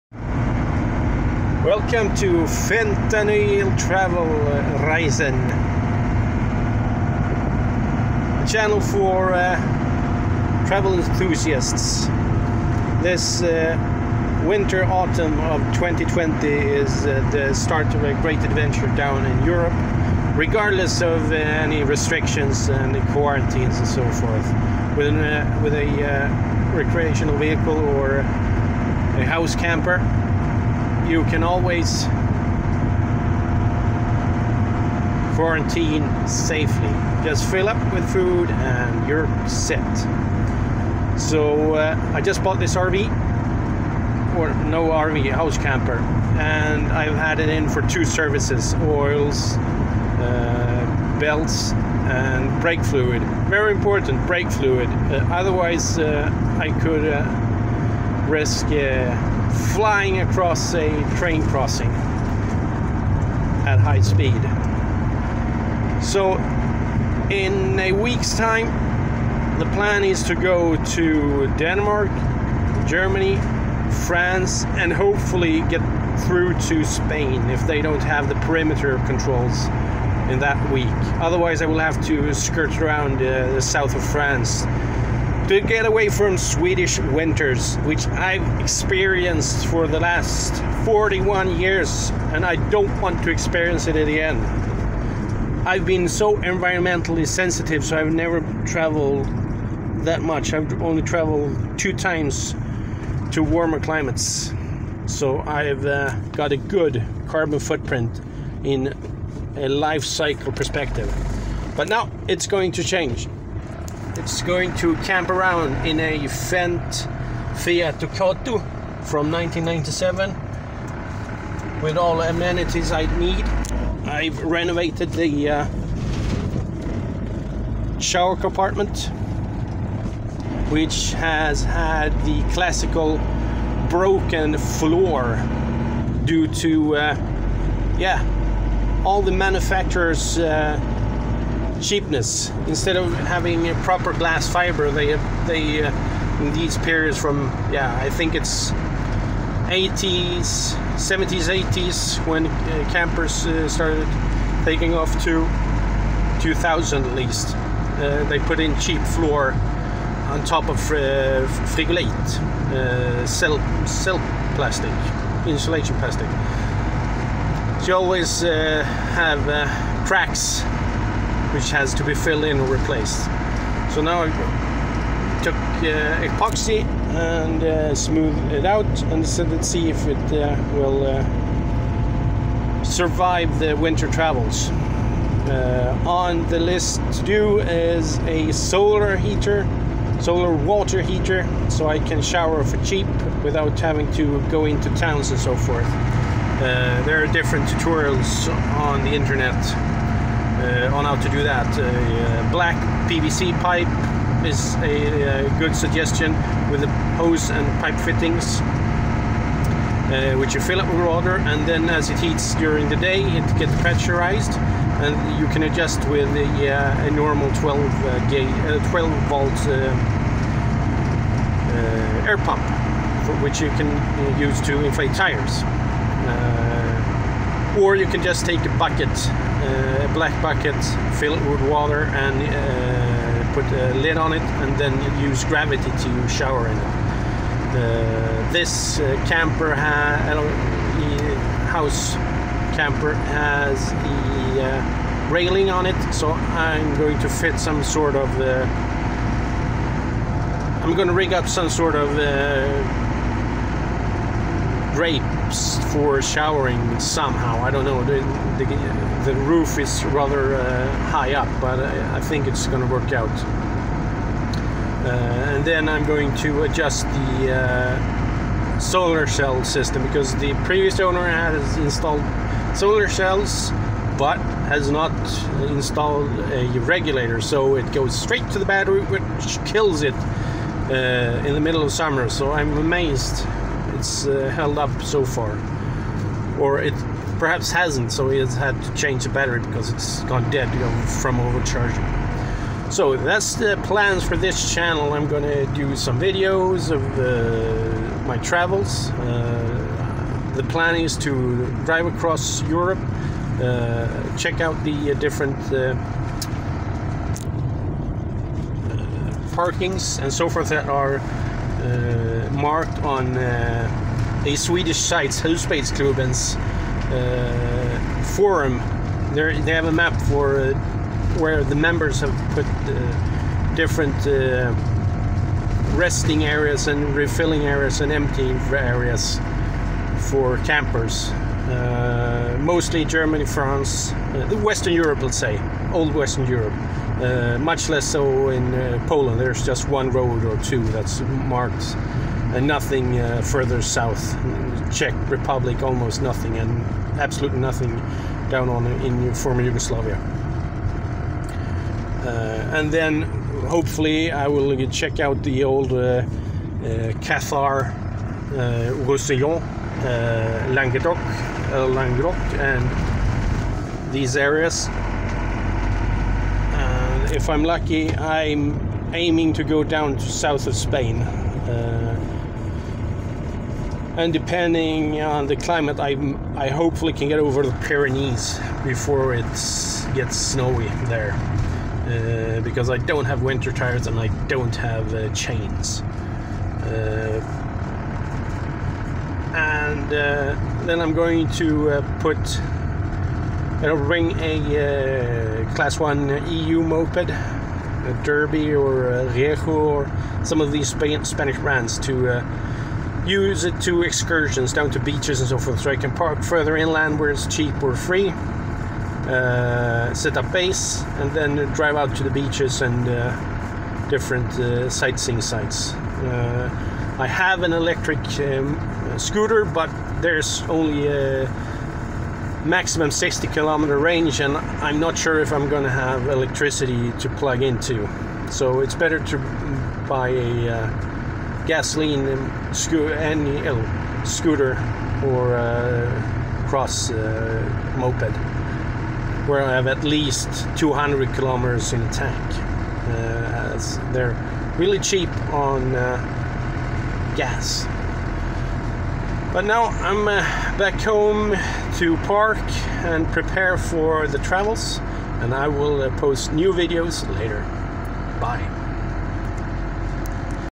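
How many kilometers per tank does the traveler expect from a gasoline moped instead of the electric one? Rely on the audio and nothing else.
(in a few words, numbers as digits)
200 kilometers.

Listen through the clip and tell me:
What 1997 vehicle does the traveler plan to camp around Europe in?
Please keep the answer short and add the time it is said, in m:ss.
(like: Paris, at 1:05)
Fendt Fiat Ducato, at 1:56.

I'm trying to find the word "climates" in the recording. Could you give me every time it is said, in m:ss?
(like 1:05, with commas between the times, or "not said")
1:43, 6:15.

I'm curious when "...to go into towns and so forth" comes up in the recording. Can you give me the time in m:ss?
3:14.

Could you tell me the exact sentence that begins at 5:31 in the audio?
Uh, mostly Germany, France, uh, Western Europe, let's say, old Western Europe.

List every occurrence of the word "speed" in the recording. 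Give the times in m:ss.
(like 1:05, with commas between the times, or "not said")
1:04.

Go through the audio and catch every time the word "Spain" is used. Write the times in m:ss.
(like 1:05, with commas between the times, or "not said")
1:16, 6:10.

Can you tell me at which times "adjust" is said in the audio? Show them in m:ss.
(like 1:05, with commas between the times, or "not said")
3:35, 4:26.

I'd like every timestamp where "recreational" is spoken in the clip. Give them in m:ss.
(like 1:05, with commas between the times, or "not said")
0:26.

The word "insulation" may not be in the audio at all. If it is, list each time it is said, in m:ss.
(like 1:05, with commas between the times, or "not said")
2:45.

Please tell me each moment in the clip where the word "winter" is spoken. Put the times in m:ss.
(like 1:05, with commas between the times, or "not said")
0:14, 1:27, 3:03, 6:23.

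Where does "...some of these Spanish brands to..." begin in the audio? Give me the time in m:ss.
6:40.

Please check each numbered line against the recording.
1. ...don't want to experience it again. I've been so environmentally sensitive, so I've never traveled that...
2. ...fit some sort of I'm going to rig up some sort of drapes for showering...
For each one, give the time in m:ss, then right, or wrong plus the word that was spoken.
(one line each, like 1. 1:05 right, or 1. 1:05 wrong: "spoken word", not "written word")
1. 1:32 right
2. 4:07 right.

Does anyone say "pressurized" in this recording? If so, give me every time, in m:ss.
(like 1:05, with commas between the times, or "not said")
3:33.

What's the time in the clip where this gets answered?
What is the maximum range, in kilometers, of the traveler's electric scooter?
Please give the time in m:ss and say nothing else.
7:03.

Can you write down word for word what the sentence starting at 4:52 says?
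So that's the plans for this channel.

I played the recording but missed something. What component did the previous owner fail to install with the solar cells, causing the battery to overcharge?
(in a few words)
regulator.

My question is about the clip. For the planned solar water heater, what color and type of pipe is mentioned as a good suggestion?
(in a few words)
black PVC pipe.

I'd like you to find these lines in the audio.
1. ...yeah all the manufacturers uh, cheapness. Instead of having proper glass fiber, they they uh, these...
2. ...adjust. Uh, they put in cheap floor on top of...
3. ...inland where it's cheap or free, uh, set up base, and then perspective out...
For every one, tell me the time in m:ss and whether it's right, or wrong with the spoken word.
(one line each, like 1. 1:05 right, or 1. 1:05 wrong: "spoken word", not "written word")
1. 2:17 right
2. 2:37 wrong: "least", not "adjust"
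3. 6:46 wrong: "drive", not "perspective".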